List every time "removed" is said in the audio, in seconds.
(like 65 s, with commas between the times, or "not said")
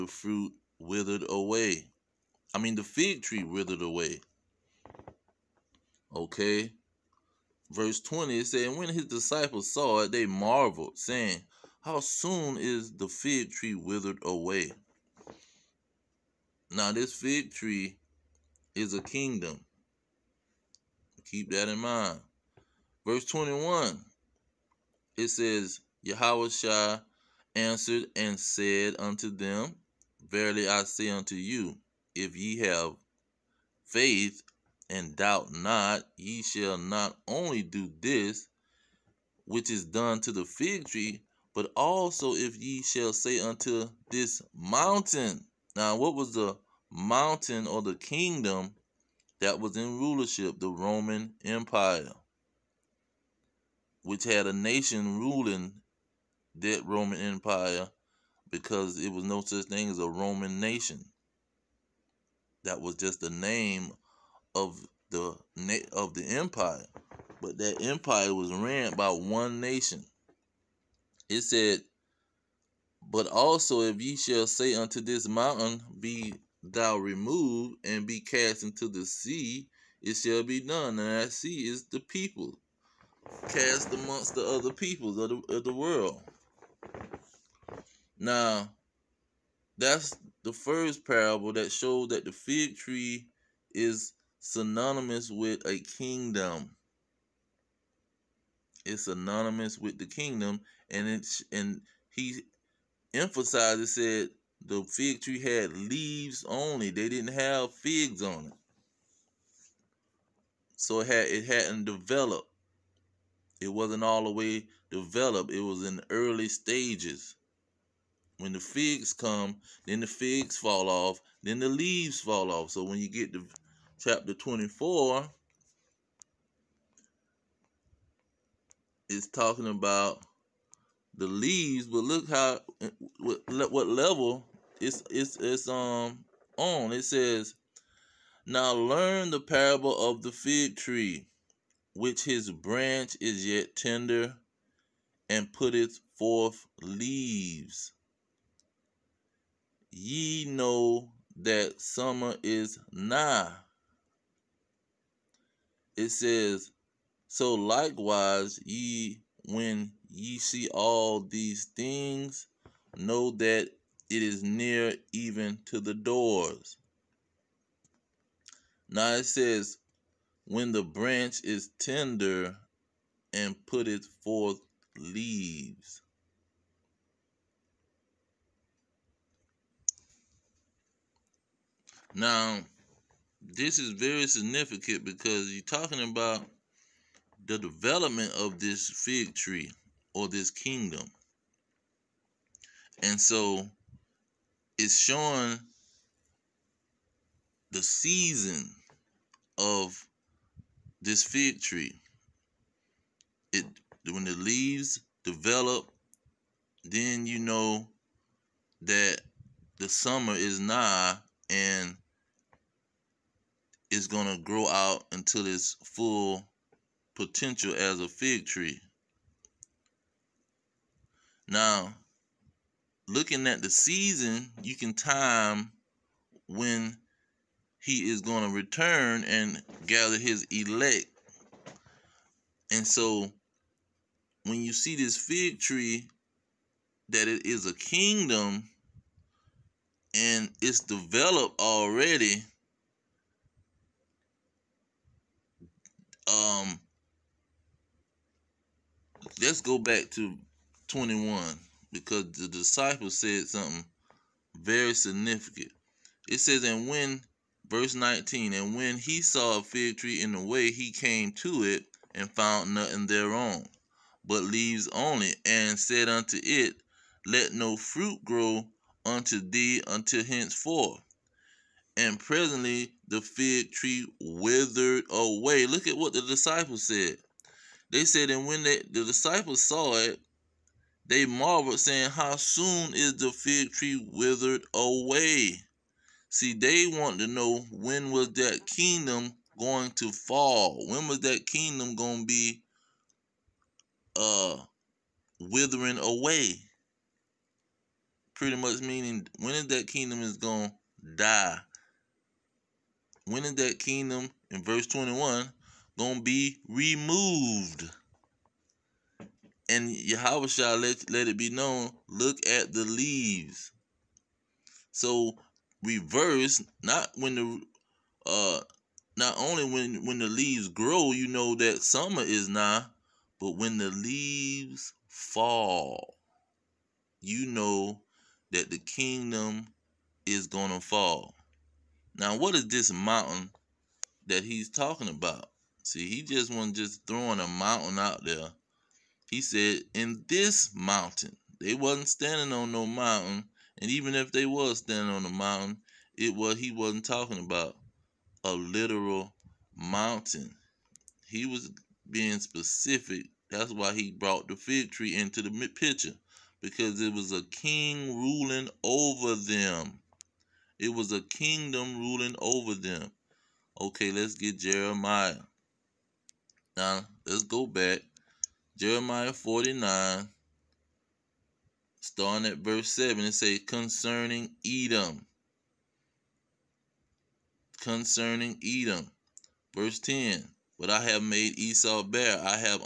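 76 s, 306 s.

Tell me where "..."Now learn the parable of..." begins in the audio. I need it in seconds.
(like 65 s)
138 s.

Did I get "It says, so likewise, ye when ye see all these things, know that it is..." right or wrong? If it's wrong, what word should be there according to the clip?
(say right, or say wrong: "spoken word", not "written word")
right.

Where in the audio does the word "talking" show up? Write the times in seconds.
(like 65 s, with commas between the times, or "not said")
129 s, 185 s, 334 s, 347 s.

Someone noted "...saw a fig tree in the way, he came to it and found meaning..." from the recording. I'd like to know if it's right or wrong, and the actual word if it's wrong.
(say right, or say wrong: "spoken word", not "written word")
wrong: "nothing", not "meaning".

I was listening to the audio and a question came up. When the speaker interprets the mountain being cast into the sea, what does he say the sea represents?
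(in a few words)
the people.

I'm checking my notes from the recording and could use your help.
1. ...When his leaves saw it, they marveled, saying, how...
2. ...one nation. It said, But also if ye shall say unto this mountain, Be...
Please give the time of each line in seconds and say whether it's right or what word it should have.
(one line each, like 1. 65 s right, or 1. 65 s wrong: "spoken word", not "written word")
1. 8 s wrong: "disciples", not "leaves"
2. 69 s right.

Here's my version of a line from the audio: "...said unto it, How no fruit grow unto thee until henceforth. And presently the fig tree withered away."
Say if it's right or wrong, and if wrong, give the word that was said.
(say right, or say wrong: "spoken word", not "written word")
wrong: "Let", not "How".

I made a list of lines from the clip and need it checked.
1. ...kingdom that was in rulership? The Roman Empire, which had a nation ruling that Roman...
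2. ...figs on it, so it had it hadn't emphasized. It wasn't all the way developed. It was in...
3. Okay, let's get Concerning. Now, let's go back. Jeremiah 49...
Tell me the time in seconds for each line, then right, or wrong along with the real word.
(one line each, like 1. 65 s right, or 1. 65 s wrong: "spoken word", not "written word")
1. 47 s right
2. 107 s wrong: "developed", not "emphasized"
3. 363 s wrong: "Jeremiah", not "Concerning".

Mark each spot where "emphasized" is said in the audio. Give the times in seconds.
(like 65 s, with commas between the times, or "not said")
103 s.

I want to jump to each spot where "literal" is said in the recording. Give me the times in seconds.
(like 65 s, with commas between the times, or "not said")
348 s.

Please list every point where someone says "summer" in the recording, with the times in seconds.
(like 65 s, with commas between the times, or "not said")
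151 s, 209 s, 321 s.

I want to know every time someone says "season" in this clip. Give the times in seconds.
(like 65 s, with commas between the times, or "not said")
197 s, 223 s.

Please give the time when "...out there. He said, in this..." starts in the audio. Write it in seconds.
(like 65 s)
337 s.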